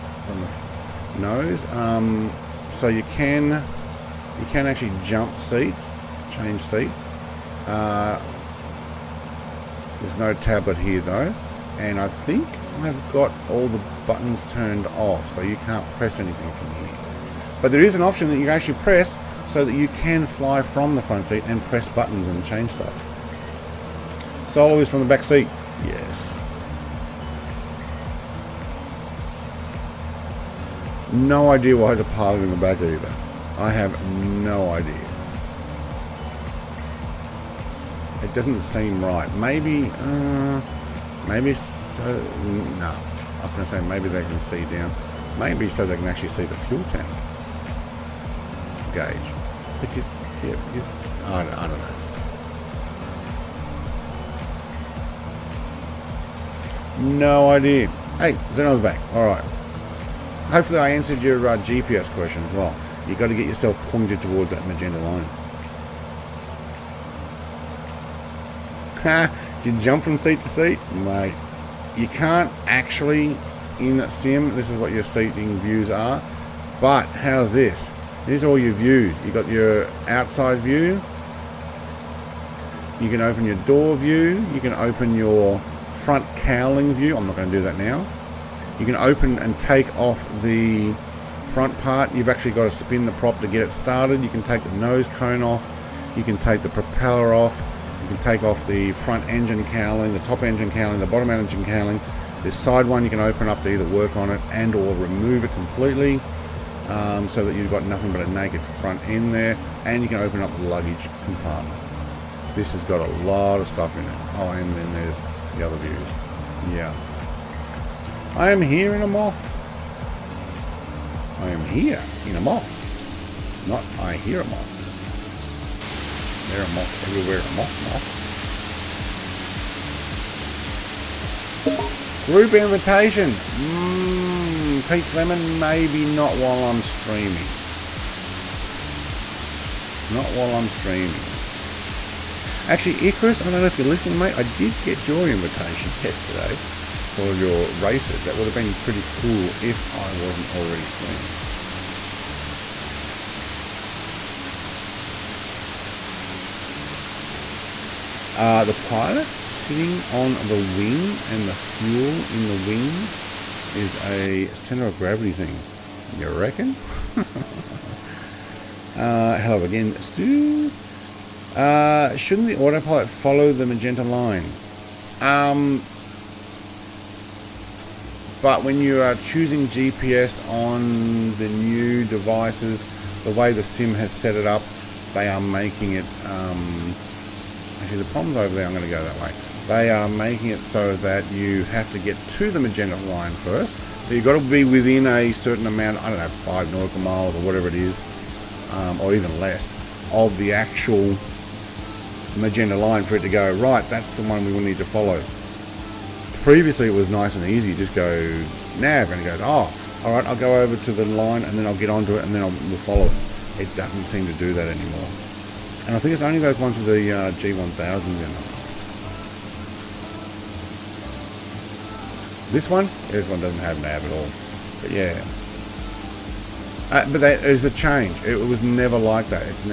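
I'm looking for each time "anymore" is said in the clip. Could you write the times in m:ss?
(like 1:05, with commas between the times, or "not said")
3:34.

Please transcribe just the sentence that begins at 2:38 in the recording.
Uh, the pilot sitting on the wing and the fuel in the wings is a center of gravity thing.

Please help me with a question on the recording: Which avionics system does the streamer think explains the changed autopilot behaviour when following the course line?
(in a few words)
G1000.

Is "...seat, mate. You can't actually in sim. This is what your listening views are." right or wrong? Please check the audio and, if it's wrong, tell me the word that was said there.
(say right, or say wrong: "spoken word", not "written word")
wrong: "seating", not "listening".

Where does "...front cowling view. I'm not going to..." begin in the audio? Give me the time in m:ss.
1:26.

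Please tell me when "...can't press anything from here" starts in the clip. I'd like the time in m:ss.
0:15.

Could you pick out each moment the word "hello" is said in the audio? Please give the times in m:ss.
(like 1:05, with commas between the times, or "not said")
2:49.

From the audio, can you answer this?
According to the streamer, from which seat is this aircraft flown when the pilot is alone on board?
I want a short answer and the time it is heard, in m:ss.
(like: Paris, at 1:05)
The back seat, at 0:24.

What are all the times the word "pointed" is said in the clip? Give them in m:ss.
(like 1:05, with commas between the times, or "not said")
1:03.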